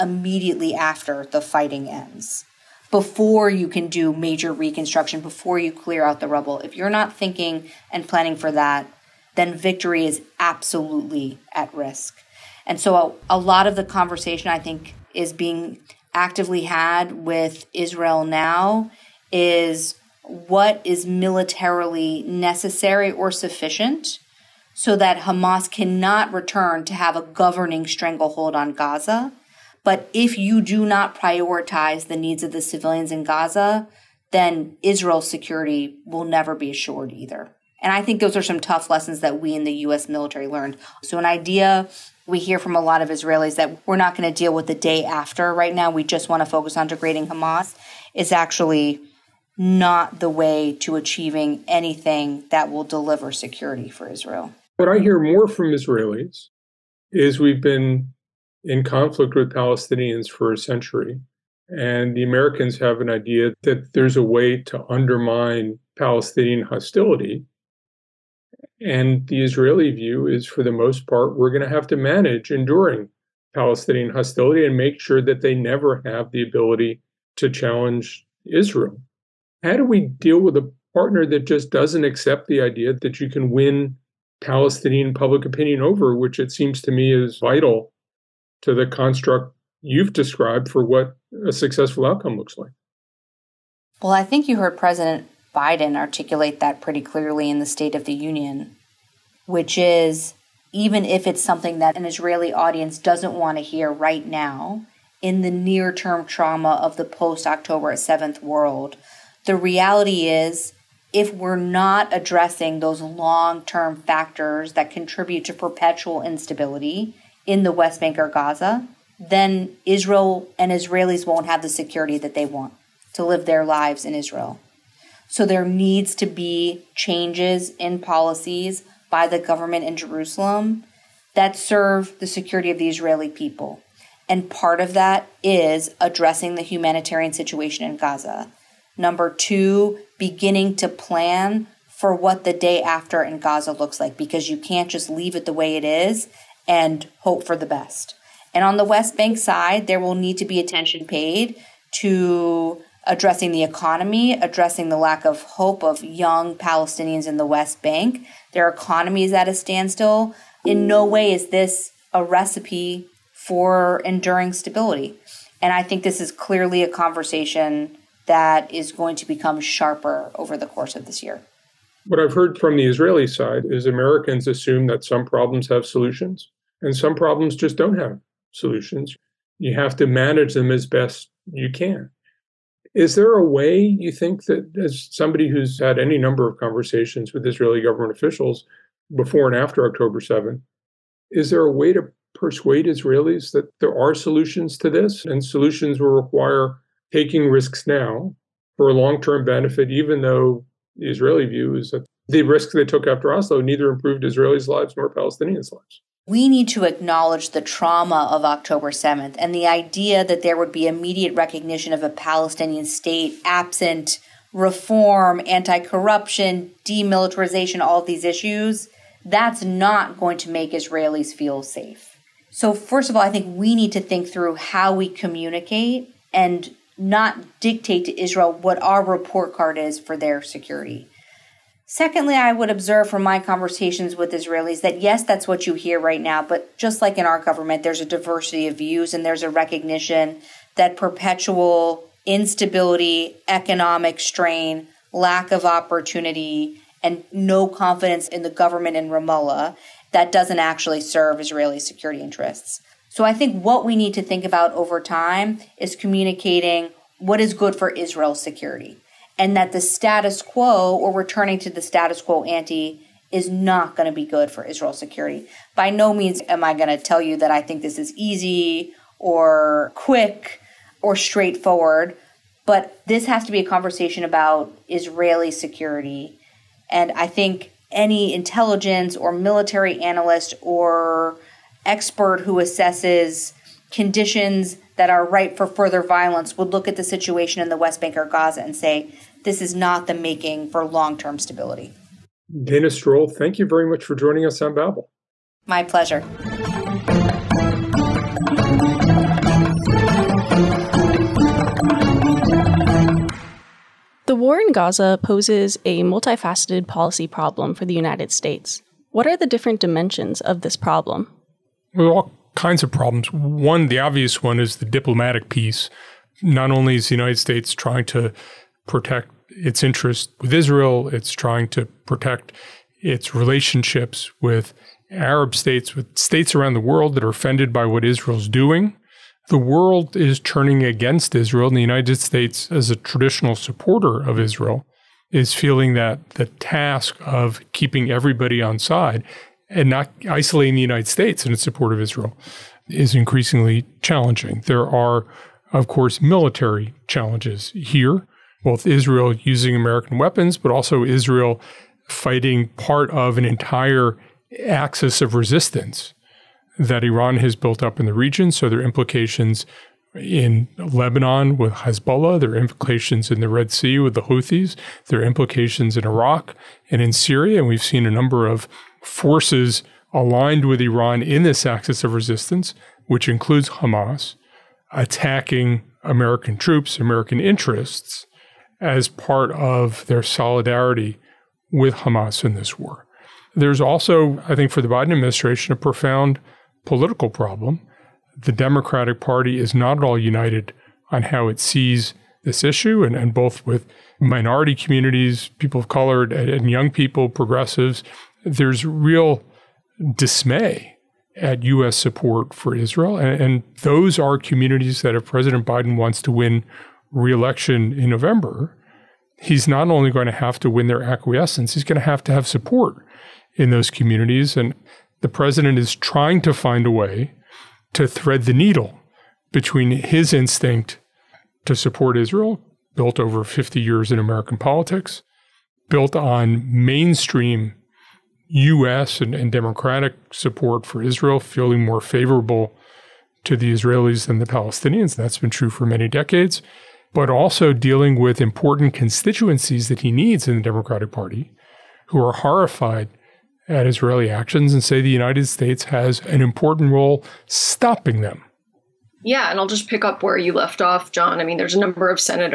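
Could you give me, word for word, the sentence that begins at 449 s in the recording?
Yeah, and I'll just pick up where you left off, Jon.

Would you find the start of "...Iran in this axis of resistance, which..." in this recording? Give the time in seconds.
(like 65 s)
370 s.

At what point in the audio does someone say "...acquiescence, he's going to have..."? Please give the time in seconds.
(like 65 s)
411 s.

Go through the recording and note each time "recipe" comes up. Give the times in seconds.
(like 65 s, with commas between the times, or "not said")
162 s.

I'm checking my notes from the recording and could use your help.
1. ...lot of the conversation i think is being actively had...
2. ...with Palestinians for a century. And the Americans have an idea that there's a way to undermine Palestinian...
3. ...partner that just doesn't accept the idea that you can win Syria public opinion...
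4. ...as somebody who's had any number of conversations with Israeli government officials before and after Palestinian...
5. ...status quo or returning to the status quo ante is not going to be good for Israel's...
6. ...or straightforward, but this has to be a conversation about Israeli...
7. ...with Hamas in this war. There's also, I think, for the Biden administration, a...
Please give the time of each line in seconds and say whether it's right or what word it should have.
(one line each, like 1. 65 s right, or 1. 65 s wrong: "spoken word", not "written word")
1. 13 s right
2. 59 s right
3. 80 s wrong: "Palestinian", not "Syria"
4. 184 s wrong: "October", not "Palestinian"
5. 259 s right
6. 271 s right
7. 381 s right.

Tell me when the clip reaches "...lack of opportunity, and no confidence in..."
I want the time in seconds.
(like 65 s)
245 s.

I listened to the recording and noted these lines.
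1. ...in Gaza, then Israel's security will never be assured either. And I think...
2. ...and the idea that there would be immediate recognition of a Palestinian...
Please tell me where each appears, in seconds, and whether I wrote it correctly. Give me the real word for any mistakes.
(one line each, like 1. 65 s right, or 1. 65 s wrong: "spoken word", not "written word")
1. 33 s right
2. 209 s right.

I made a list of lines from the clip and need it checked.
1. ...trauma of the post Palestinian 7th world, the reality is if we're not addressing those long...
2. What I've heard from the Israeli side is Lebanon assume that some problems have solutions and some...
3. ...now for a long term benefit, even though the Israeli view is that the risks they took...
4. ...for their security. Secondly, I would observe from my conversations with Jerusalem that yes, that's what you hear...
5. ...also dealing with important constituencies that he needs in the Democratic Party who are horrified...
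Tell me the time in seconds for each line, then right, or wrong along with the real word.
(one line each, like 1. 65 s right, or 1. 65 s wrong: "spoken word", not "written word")
1. 106 s wrong: "October", not "Palestinian"
2. 172 s wrong: "Americans", not "Lebanon"
3. 197 s right
4. 229 s wrong: "Israelis", not "Jerusalem"
5. 437 s right.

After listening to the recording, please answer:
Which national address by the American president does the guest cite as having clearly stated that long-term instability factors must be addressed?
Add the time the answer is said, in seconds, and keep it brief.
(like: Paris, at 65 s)
State of the Union, at 97 s.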